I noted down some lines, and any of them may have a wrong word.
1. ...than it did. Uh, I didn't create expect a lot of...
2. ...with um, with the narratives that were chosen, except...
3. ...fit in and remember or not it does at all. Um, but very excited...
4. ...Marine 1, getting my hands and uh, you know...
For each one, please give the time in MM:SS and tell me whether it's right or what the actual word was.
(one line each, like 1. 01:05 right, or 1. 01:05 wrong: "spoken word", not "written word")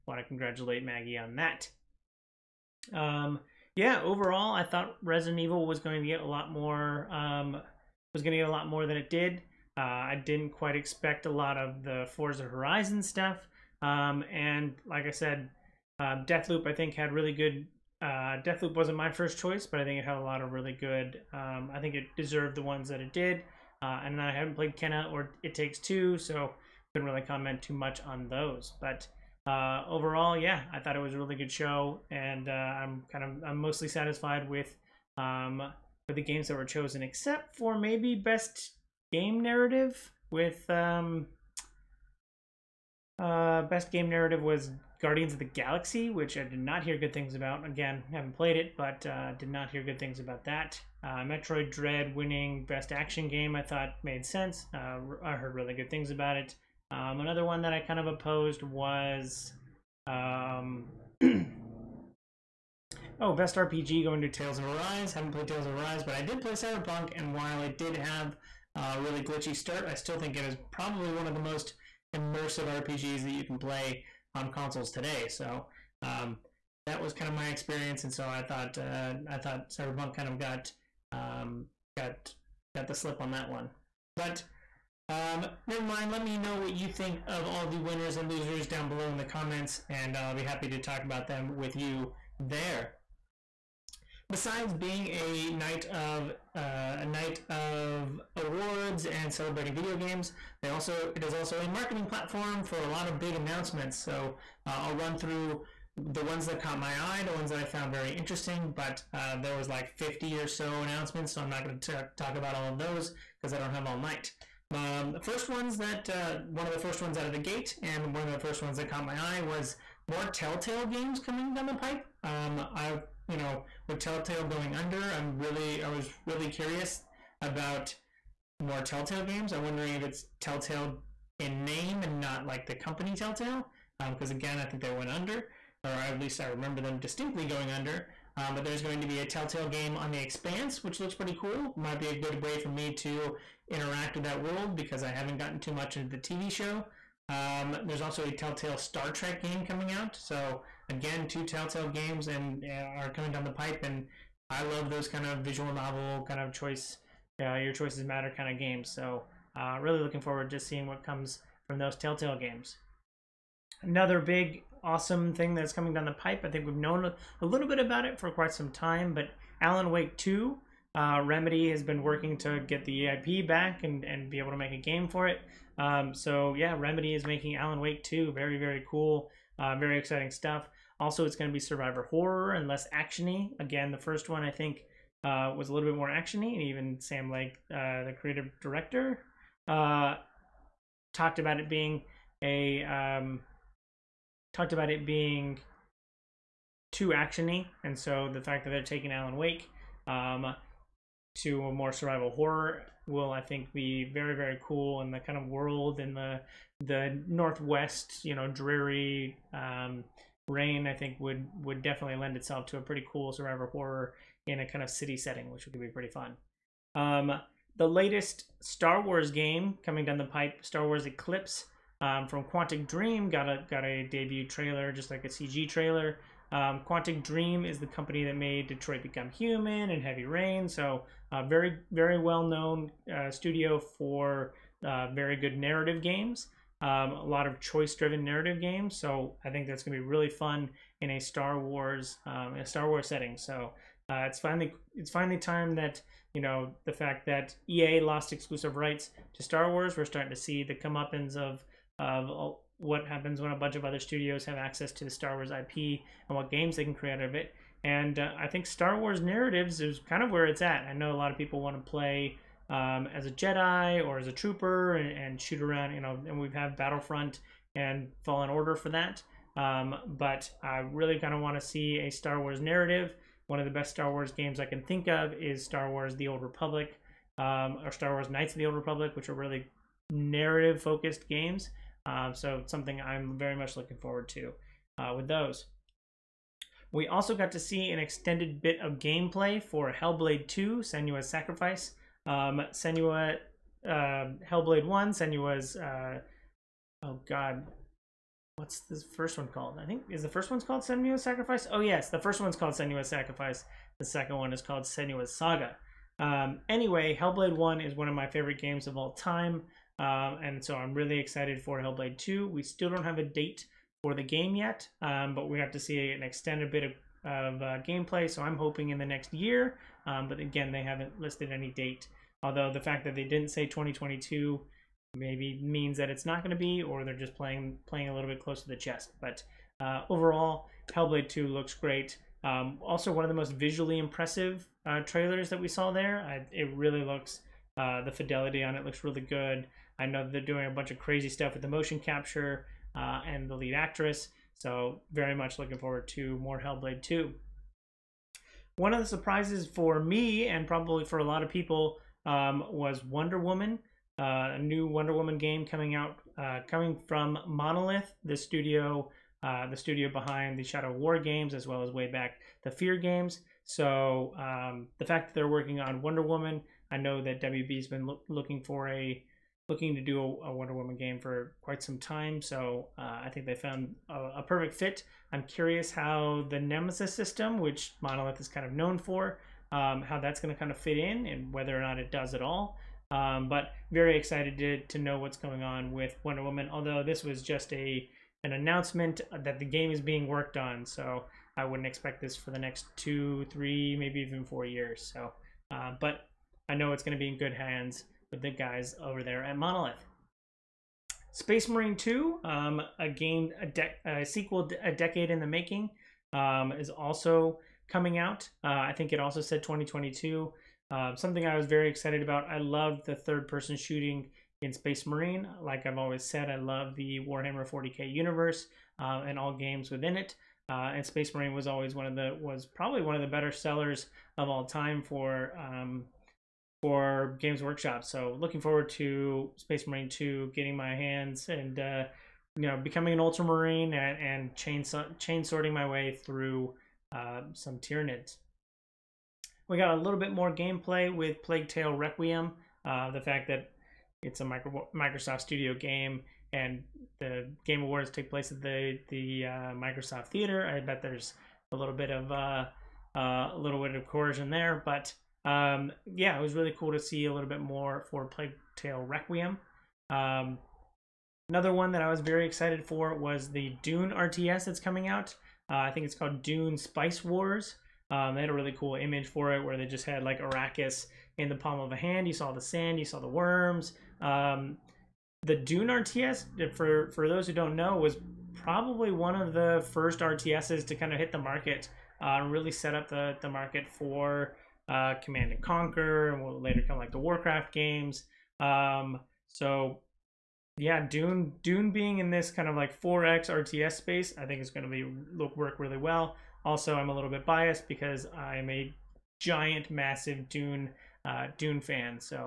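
1. 00:08 wrong: "quite", not "create"
2. 00:34 wrong: "games", not "narratives"
3. 06:20 wrong: "whether", not "remember"
4. 07:09 wrong: "2", not "1".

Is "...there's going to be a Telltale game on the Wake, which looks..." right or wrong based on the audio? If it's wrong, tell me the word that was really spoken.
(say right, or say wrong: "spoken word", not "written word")
wrong: "Expanse", not "Wake".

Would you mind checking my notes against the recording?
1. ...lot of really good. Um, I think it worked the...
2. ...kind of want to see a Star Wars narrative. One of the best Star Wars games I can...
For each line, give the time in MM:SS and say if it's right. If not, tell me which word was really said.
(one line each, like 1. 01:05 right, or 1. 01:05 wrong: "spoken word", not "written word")
1. 00:20 wrong: "deserved", not "worked"
2. 04:31 right.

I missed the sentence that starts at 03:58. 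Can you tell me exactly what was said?
So I think that's going to be really fun in a Star Wars um, a Star Wars setting.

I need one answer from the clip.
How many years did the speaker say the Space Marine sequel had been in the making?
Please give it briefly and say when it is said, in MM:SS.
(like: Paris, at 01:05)
A decade, at 06:44.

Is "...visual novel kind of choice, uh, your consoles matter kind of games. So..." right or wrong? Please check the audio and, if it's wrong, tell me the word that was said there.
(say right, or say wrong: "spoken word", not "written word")
wrong: "choices", not "consoles".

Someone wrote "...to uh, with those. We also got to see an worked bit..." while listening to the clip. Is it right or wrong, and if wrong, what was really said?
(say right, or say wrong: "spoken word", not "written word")
wrong: "extended", not "worked".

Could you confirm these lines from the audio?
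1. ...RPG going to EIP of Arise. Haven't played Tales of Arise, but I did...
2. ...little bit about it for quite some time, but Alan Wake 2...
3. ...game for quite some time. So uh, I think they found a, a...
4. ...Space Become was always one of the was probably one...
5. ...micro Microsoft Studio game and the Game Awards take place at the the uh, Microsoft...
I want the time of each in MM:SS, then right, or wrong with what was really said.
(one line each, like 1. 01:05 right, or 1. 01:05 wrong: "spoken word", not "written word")
1. 01:03 wrong: "Tales", not "EIP"
2. 02:47 right
3. 06:10 right
4. 07:01 wrong: "Marine", not "Become"
5. 07:24 right.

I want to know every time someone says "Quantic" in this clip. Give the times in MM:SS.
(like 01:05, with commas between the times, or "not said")
03:42, 03:46.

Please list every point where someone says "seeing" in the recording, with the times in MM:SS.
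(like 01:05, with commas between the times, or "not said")
02:40.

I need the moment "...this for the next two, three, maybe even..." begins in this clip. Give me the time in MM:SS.
06:32.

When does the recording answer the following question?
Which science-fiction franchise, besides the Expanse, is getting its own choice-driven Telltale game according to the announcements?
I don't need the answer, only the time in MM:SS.
02:28.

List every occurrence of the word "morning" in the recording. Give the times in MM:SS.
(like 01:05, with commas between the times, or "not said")
not said.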